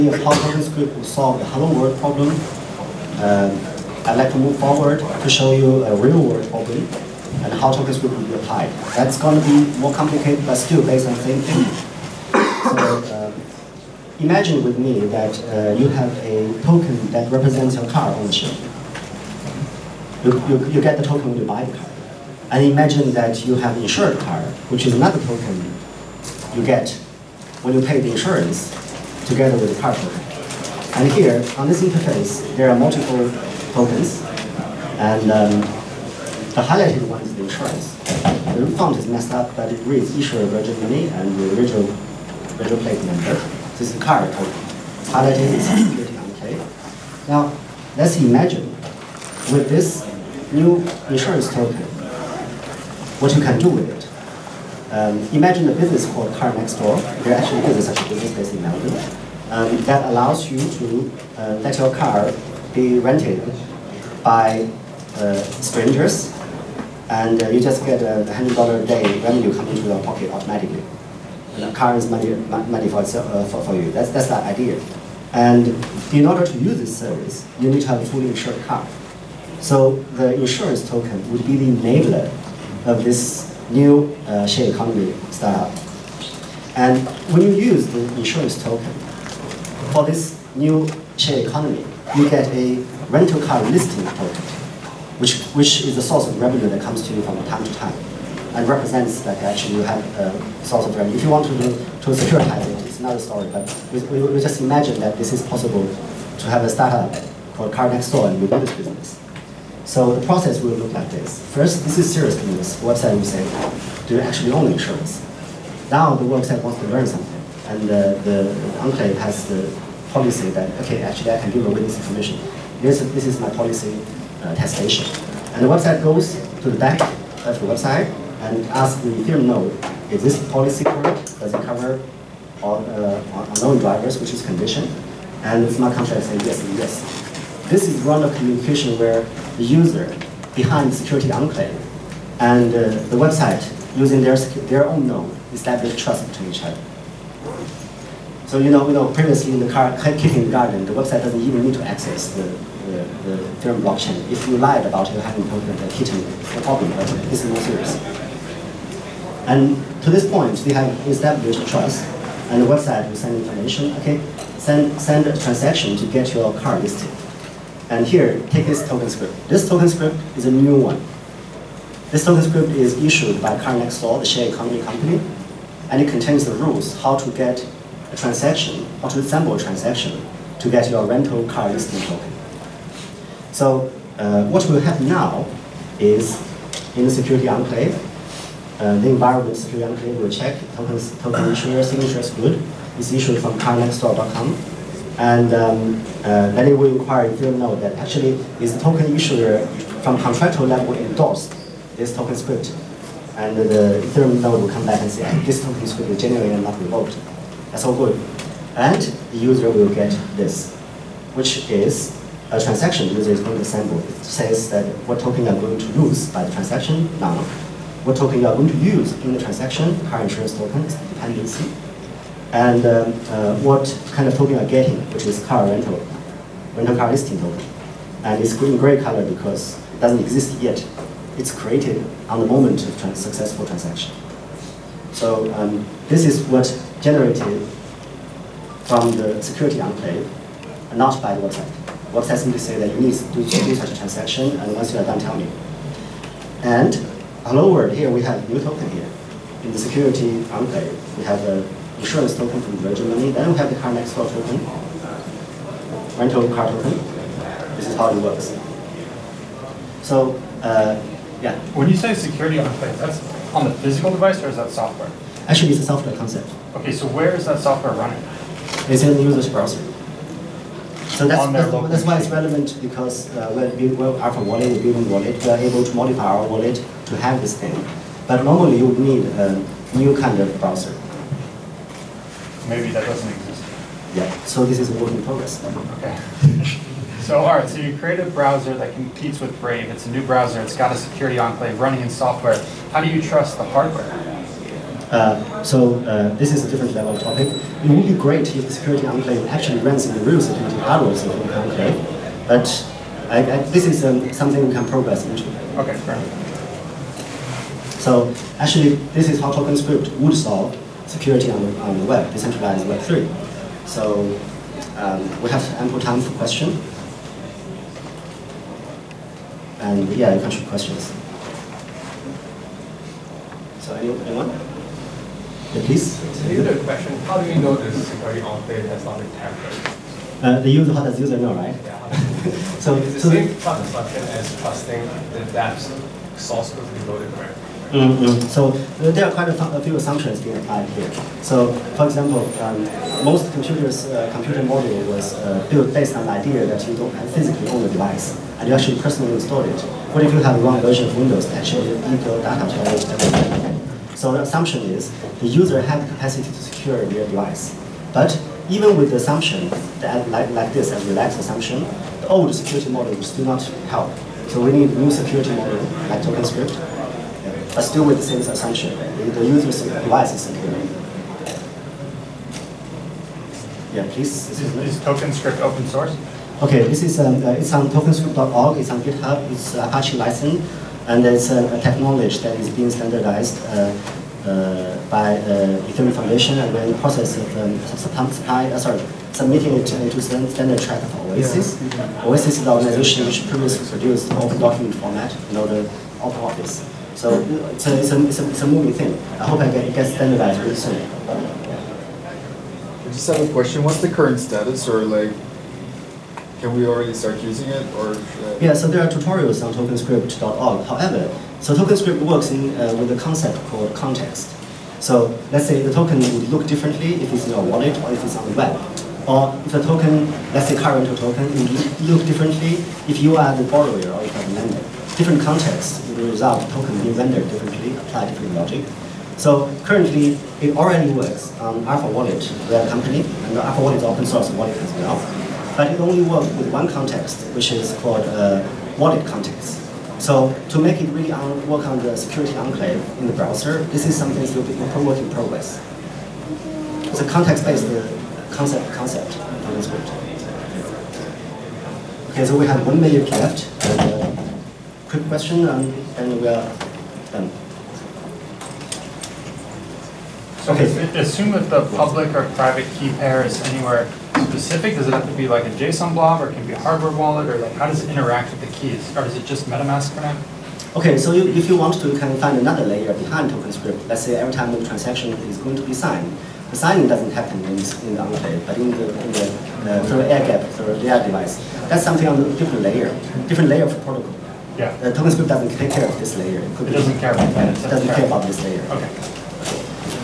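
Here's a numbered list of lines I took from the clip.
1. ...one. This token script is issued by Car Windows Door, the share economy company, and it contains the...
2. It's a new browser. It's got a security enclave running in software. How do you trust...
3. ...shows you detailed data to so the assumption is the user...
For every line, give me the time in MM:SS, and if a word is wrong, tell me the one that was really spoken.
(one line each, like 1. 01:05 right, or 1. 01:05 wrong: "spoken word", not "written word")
1. 02:50 wrong: "Next", not "Windows"
2. 04:49 right
3. 05:51 right.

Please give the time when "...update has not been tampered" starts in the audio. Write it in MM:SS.
05:28.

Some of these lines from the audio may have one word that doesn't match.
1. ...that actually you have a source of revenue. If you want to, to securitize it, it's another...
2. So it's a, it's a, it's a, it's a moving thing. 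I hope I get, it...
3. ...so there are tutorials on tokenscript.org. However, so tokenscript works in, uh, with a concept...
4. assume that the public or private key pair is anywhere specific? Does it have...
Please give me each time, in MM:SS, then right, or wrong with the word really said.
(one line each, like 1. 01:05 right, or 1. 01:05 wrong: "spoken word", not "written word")
1. 01:39 right
2. 06:37 right
3. 06:48 right
4. 07:41 right.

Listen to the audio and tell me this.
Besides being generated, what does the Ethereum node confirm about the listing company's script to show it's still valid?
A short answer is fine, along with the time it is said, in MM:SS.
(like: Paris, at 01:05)
not revoked, at 03:26.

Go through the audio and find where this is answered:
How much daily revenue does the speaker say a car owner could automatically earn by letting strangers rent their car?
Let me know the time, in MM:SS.
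01:08.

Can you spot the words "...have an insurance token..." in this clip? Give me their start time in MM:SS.
04:11.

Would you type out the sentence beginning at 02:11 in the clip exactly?
Does it cover all uh, unknown drivers, which is condition?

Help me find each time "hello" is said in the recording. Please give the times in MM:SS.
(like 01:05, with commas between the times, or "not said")
00:01, 04:07.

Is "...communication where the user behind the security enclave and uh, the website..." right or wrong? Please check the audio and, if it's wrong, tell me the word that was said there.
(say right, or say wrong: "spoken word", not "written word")
right.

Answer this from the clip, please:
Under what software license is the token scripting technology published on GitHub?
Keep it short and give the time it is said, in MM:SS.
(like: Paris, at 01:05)
Apache, at 06:19.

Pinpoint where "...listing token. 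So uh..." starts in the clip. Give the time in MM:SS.
03:01.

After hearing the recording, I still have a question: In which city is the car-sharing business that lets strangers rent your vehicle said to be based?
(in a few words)
Melbourne.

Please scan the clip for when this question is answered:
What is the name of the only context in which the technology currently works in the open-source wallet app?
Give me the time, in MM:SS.
07:18.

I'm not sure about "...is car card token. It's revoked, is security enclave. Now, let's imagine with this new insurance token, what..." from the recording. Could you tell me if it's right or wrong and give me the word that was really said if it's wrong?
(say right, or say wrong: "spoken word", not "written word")
wrong: "highlighted", not "revoked".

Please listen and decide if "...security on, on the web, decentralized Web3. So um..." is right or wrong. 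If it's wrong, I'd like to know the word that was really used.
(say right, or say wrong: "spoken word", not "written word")
right.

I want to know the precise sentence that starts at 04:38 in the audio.
But normally you would need a new kind of browser.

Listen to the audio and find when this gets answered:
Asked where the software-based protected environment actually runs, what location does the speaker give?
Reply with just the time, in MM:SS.
04:29.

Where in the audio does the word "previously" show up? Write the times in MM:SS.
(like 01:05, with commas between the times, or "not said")
02:29, 06:33.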